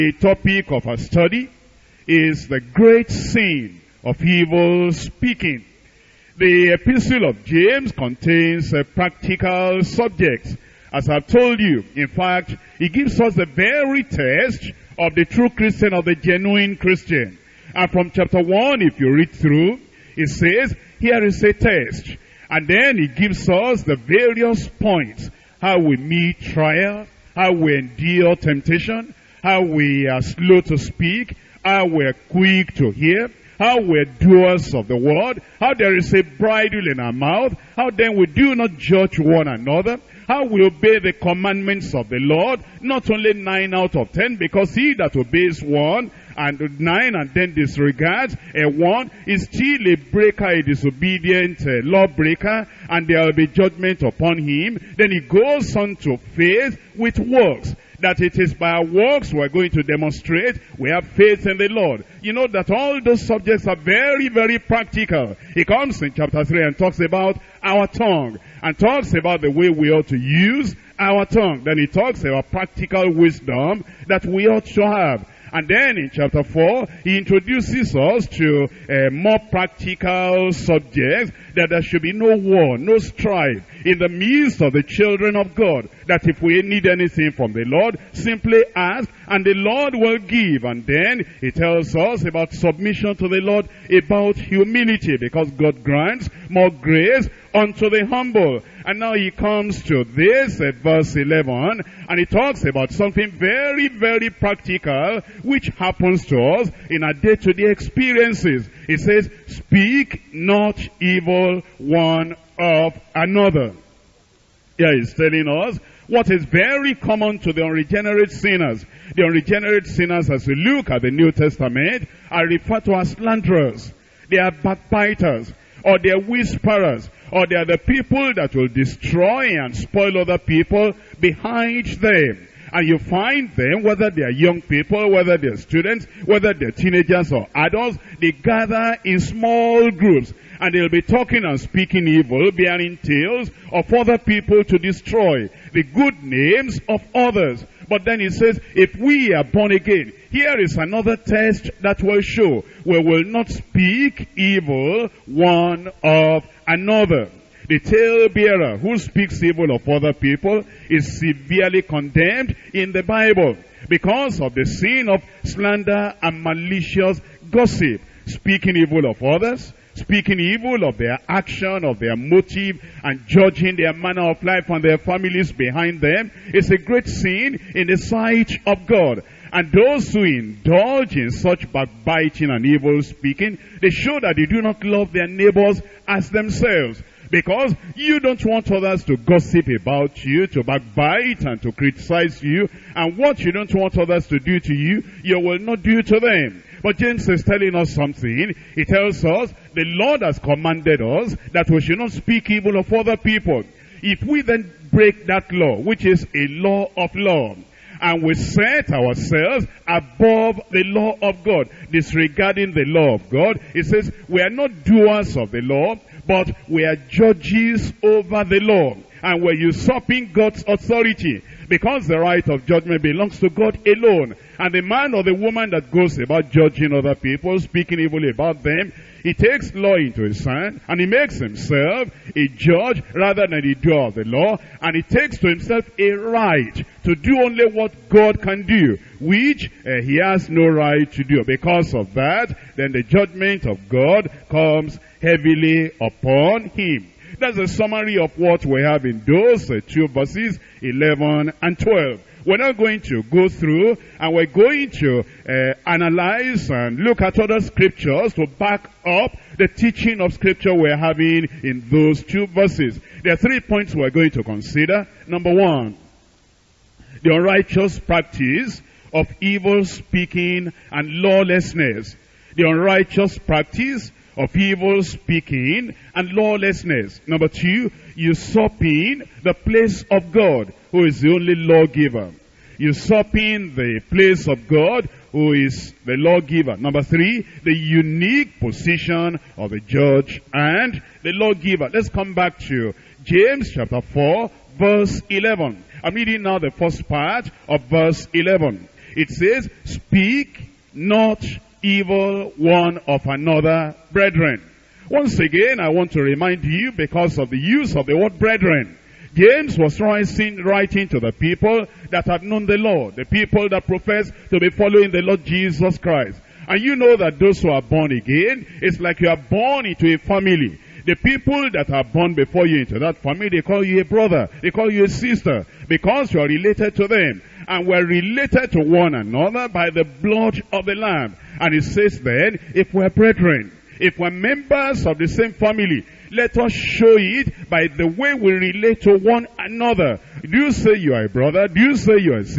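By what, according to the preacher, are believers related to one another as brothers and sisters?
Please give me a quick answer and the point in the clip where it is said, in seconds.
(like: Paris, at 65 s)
the blood of the Lamb, at 330 s.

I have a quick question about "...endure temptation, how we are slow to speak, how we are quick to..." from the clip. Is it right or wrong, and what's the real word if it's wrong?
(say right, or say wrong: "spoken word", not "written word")
right.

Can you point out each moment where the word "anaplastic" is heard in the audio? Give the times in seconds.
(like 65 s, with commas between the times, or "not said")
not said.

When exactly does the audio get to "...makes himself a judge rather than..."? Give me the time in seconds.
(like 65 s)
231 s.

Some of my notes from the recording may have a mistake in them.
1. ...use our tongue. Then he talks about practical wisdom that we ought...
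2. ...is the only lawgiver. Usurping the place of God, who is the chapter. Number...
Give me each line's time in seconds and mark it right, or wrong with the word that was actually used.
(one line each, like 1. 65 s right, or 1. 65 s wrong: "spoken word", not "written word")
1. 70 s right
2. 281 s wrong: "lawgiver", not "chapter".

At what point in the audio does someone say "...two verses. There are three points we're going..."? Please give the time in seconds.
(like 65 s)
262 s.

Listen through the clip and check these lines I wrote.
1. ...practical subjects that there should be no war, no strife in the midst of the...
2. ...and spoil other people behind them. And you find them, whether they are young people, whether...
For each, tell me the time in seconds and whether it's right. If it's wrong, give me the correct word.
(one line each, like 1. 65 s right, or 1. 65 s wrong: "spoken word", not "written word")
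1. 79 s right
2. 129 s right.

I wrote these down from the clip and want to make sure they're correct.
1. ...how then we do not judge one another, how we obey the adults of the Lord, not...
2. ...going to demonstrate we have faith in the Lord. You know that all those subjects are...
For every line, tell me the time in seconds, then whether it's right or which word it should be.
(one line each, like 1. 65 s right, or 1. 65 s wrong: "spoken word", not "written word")
1. 37 s wrong: "commandments", not "adults"
2. 59 s right.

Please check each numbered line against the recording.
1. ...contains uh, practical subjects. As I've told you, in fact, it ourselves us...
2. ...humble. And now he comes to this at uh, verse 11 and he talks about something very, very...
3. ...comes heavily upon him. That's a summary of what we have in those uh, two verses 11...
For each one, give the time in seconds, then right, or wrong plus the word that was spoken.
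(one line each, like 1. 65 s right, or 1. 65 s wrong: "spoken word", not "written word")
1. 7 s wrong: "gives", not "ourselves"
2. 98 s right
3. 244 s right.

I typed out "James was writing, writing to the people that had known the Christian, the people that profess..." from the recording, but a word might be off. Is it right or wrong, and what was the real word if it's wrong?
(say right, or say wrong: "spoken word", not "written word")
wrong: "Lord", not "Christian".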